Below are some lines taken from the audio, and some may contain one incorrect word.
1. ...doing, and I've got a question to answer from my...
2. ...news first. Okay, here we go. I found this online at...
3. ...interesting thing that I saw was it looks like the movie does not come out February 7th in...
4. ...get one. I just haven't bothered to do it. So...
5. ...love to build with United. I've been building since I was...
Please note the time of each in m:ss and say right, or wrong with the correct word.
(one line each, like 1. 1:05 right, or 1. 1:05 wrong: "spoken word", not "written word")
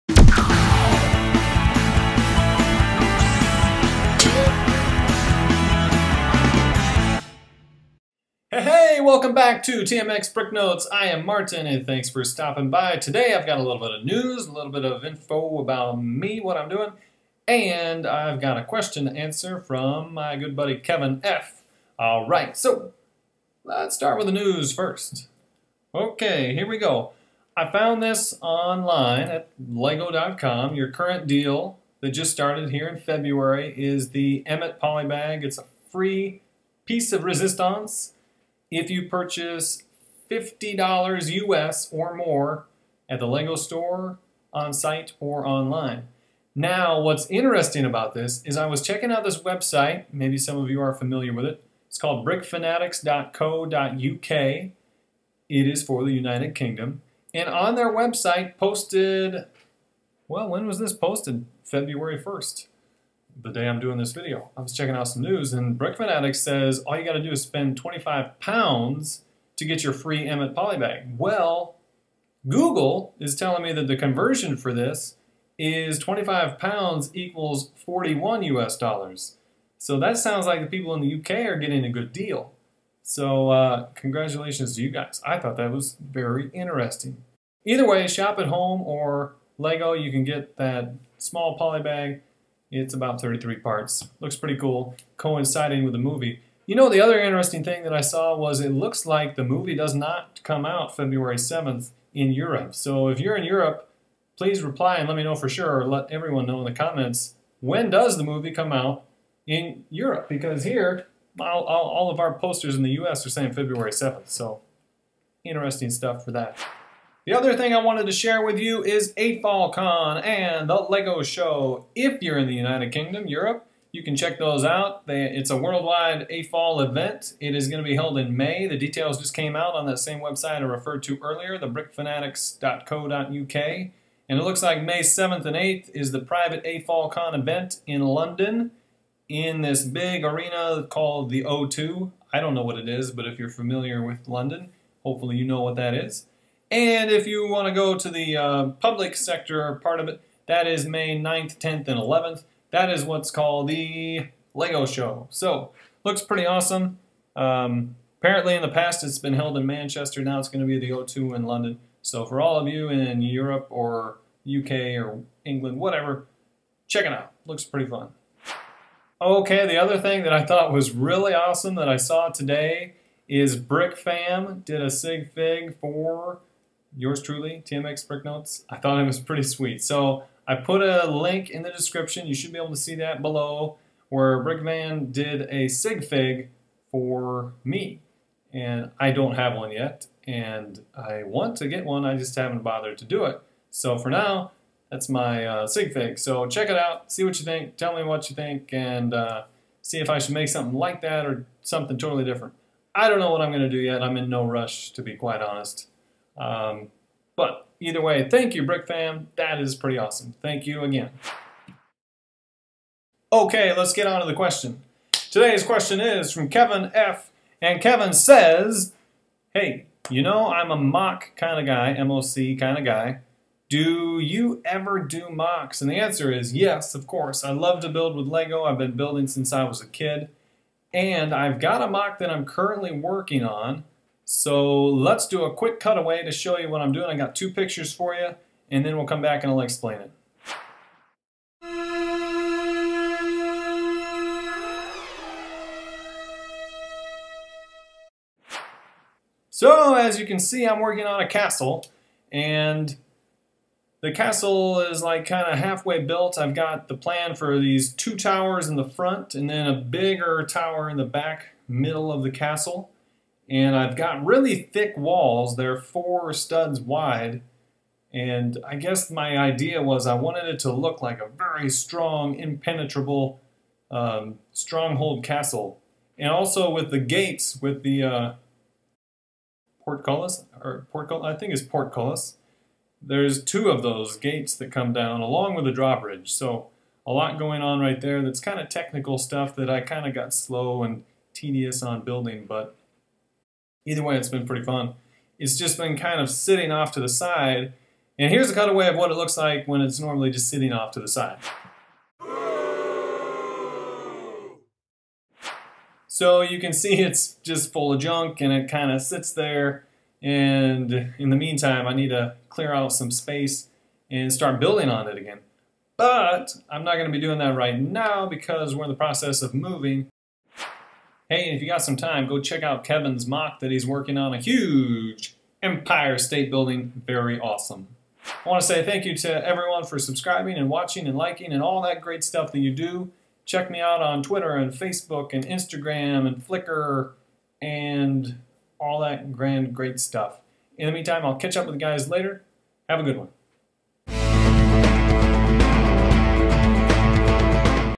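1. 0:16 right
2. 0:24 right
3. 1:37 right
4. 3:11 right
5. 3:47 wrong: "Lego", not "United".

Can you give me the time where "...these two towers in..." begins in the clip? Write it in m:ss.
4:17.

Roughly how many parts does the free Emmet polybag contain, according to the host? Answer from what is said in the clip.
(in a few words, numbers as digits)
33.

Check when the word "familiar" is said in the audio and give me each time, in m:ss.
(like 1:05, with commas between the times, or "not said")
0:50, 2:23.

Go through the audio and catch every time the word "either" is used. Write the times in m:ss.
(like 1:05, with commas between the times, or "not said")
1:27, 3:27, 4:53.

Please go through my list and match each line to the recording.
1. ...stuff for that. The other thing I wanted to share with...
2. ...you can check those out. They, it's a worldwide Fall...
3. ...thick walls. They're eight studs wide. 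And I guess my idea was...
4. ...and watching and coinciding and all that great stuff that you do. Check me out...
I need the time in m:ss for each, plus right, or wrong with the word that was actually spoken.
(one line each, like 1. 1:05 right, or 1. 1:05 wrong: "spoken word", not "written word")
1. 1:55 right
2. 2:03 right
3. 4:24 wrong: "four", not "eight"
4. 5:30 wrong: "liking", not "coinciding".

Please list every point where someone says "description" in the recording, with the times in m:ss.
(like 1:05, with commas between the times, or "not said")
3:01.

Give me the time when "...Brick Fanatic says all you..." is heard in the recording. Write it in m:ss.
1:05.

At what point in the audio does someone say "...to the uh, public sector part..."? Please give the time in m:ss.
2:27.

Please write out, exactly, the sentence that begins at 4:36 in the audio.
And also with the gates, with the uh, portcullis, or portcullis, I think it's portcullis.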